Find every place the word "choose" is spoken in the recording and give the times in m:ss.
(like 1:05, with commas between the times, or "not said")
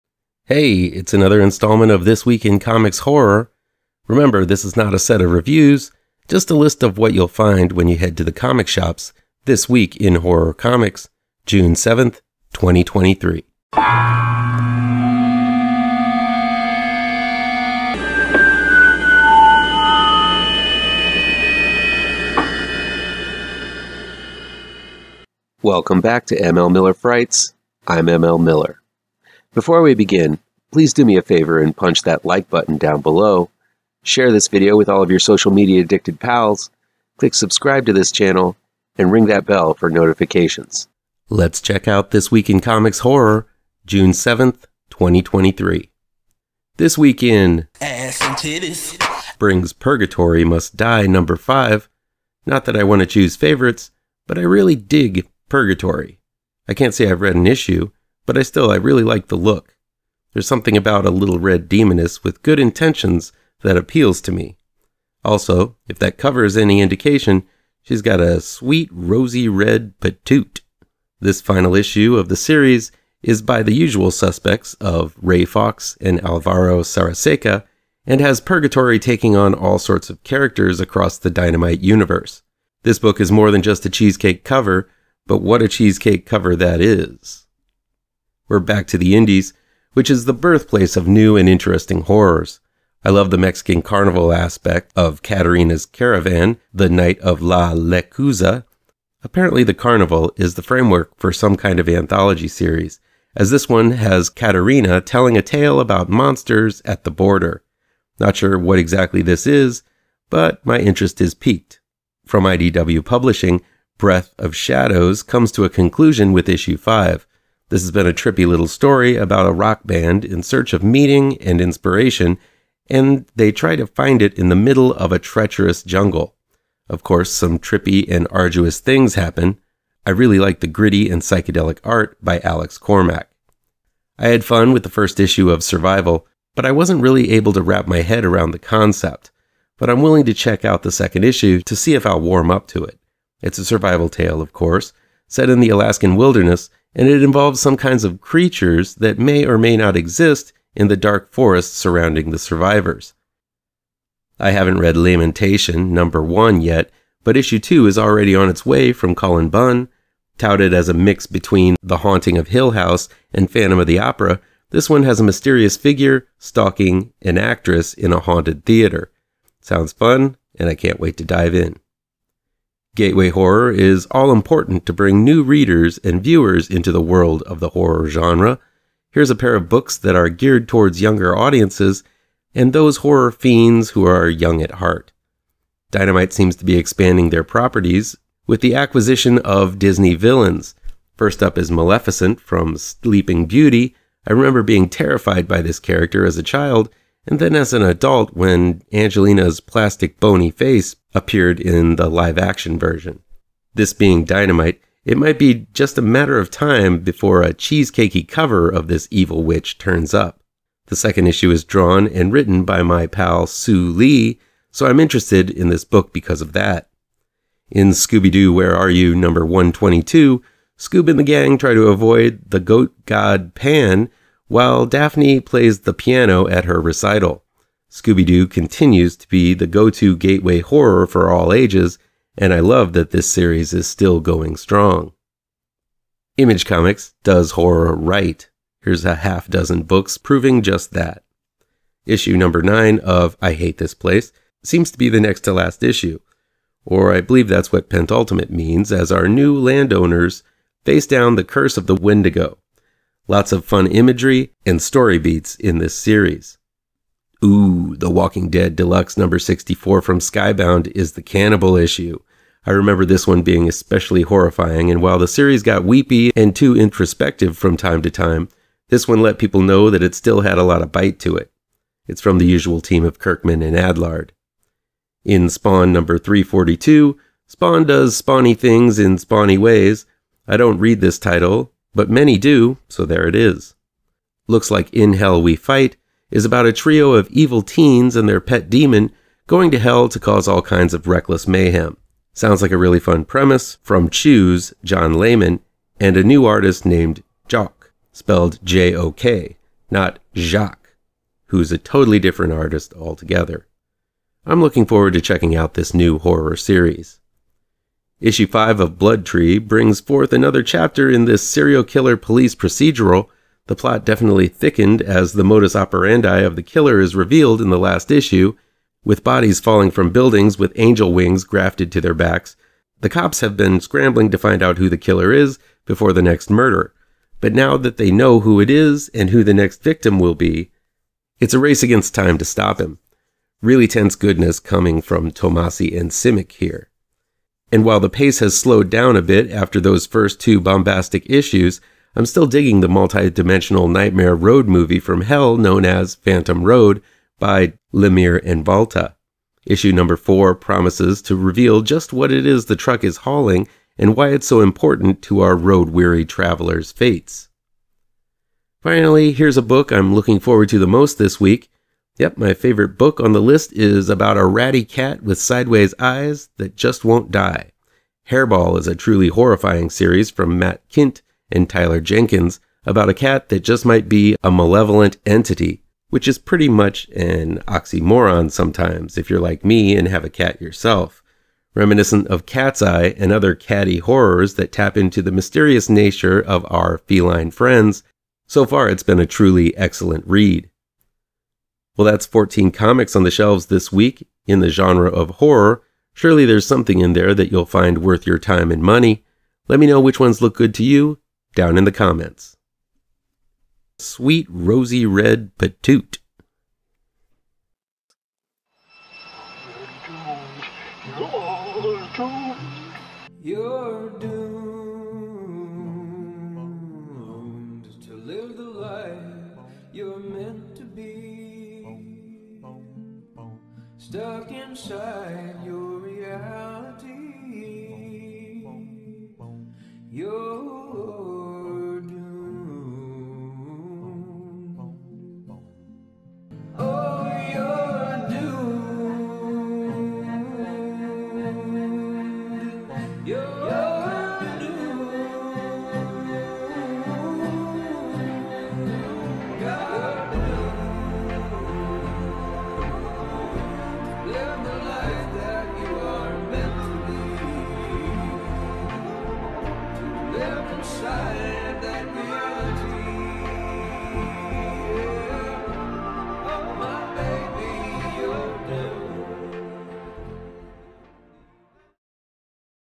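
0:53, 4:54.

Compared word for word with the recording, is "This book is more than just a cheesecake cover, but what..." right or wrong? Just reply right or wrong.
right.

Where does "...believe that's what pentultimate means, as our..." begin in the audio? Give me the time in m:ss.
4:07.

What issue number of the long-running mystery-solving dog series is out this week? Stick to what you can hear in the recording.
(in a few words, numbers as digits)
122.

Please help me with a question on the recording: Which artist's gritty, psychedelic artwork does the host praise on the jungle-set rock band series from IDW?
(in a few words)
Alex Cormack.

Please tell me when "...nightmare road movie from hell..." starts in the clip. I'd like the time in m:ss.
5:43.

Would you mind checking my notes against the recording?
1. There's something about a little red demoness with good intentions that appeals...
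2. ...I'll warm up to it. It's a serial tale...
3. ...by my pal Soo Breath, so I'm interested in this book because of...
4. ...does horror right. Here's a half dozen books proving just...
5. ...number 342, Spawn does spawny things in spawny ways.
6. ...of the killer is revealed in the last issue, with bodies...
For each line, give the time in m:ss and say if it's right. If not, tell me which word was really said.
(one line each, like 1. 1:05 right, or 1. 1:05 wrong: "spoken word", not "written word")
1. 1:00 right
2. 2:22 wrong: "survival", not "serial"
3. 3:32 wrong: "Lee", not "Breath"
4. 3:57 right
5. 4:35 right
6. 5:16 right.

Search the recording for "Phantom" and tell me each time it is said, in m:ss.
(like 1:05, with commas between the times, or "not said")
2:43, 5:46.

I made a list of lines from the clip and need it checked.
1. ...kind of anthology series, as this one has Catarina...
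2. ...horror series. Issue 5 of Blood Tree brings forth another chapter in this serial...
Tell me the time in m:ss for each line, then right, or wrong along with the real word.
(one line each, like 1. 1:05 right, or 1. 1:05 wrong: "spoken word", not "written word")
1. 1:41 right
2. 5:06 right.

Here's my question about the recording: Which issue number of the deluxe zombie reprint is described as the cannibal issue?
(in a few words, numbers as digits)
64.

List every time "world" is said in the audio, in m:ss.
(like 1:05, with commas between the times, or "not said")
2:57.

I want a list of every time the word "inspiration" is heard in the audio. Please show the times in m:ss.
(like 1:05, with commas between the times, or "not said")
2:01.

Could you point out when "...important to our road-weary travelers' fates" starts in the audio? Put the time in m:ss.
5:54.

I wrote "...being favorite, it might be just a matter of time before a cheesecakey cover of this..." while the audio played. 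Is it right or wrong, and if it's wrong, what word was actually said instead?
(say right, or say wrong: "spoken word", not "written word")
wrong: "dynamite", not "favorite".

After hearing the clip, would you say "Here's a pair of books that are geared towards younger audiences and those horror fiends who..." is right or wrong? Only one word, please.
right.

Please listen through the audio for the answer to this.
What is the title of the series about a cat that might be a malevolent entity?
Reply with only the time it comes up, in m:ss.
6:08.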